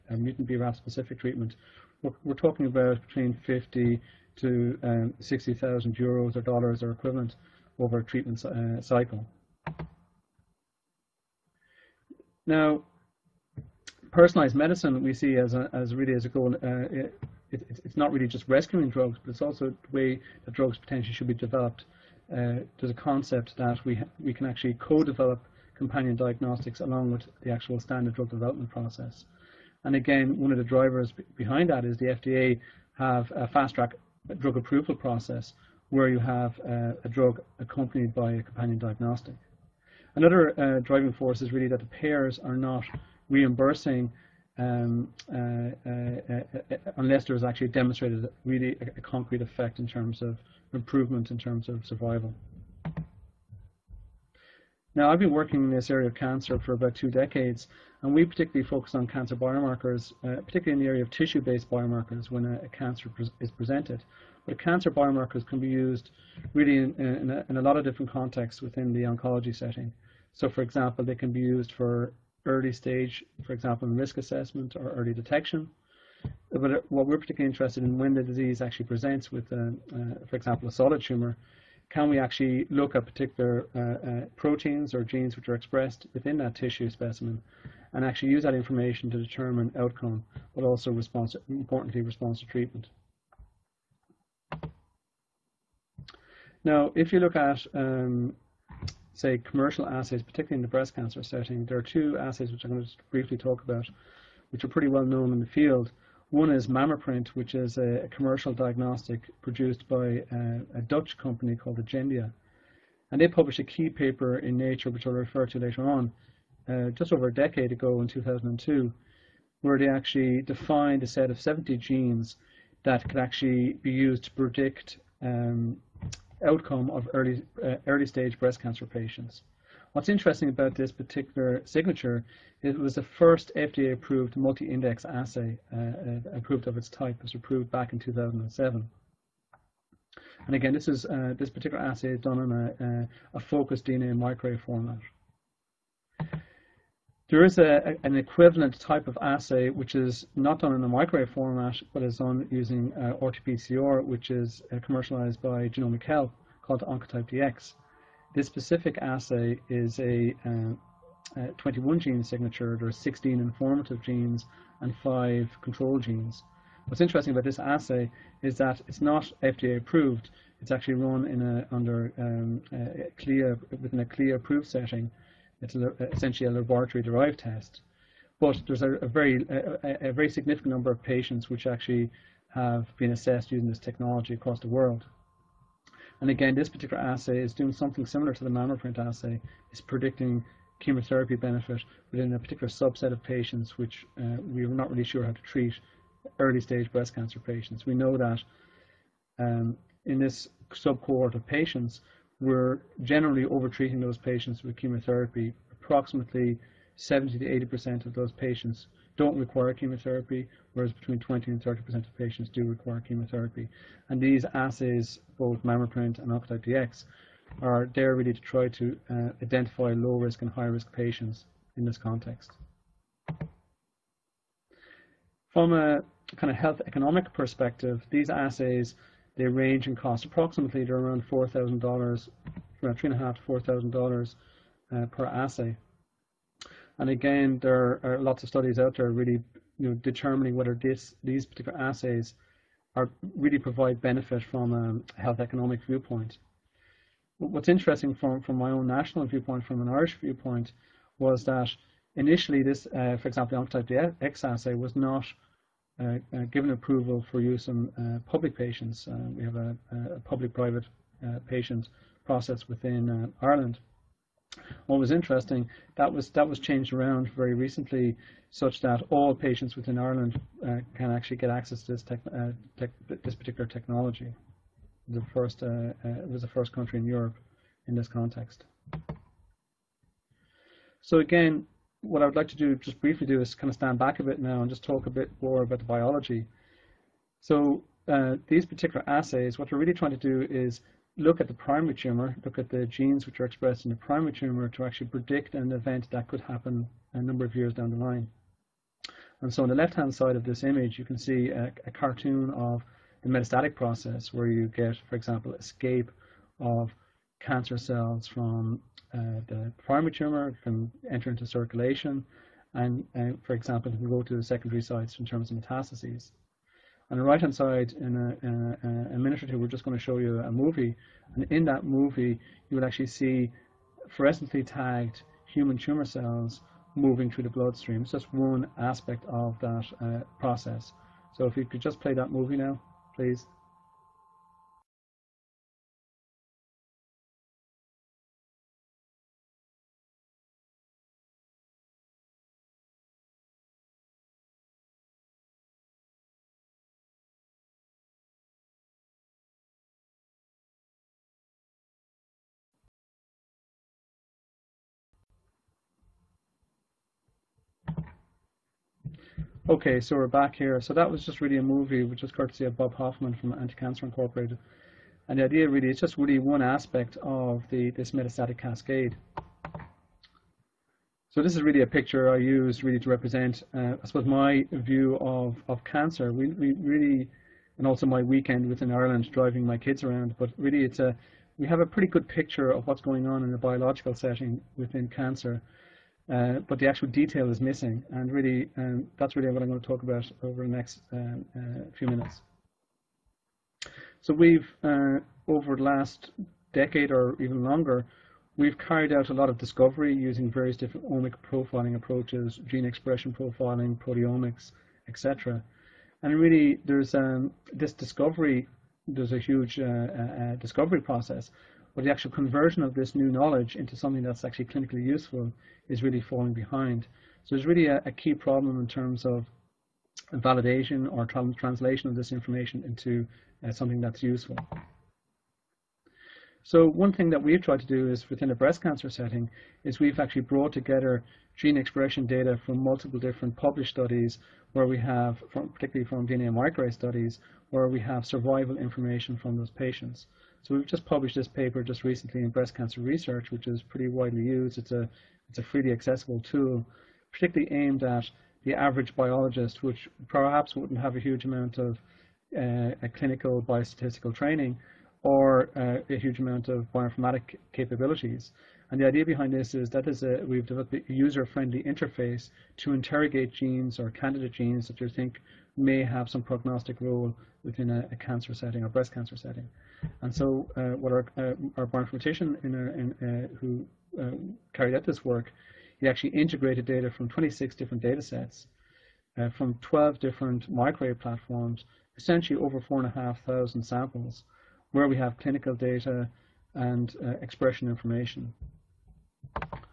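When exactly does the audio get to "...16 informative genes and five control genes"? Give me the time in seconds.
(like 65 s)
162 s.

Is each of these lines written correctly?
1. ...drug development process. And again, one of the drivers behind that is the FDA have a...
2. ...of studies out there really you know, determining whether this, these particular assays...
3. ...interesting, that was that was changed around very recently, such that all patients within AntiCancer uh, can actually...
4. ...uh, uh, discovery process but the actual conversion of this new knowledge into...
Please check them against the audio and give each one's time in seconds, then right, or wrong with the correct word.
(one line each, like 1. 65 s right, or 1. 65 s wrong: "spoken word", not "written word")
1. 28 s right
2. 238 s right
3. 265 s wrong: "Ireland", not "AntiCancer"
4. 409 s right.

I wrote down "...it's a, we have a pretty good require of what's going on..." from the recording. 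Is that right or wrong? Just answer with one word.
wrong.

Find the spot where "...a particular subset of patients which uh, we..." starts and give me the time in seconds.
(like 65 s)
192 s.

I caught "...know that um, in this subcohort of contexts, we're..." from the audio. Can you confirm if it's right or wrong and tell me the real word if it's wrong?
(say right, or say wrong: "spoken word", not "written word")
wrong: "patients", not "contexts".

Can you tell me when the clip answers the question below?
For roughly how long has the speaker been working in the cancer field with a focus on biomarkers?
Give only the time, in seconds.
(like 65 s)
56 s.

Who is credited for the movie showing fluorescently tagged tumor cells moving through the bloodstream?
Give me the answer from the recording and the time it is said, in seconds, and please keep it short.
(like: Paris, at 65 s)
Bob Hoffman, at 362 s.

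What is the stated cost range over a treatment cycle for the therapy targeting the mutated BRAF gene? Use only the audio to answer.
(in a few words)
50 to 60,000 euros.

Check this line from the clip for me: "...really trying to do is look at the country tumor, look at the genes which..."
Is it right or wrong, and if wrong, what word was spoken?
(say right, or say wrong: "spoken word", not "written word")
wrong: "primary", not "country".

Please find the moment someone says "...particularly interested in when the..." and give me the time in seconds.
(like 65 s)
77 s.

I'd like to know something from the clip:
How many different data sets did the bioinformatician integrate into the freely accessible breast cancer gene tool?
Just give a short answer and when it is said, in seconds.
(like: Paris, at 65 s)
26, at 477 s.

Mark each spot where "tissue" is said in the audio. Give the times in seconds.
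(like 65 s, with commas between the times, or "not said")
61 s, 86 s.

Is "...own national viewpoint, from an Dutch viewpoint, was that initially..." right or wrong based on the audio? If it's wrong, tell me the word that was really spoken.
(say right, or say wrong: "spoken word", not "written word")
wrong: "Irish", not "Dutch".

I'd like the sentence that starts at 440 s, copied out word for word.
So we've just published this paper just recently in breast cancer research, which is pretty widely used.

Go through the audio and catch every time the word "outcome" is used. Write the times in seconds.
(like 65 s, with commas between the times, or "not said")
89 s, 126 s.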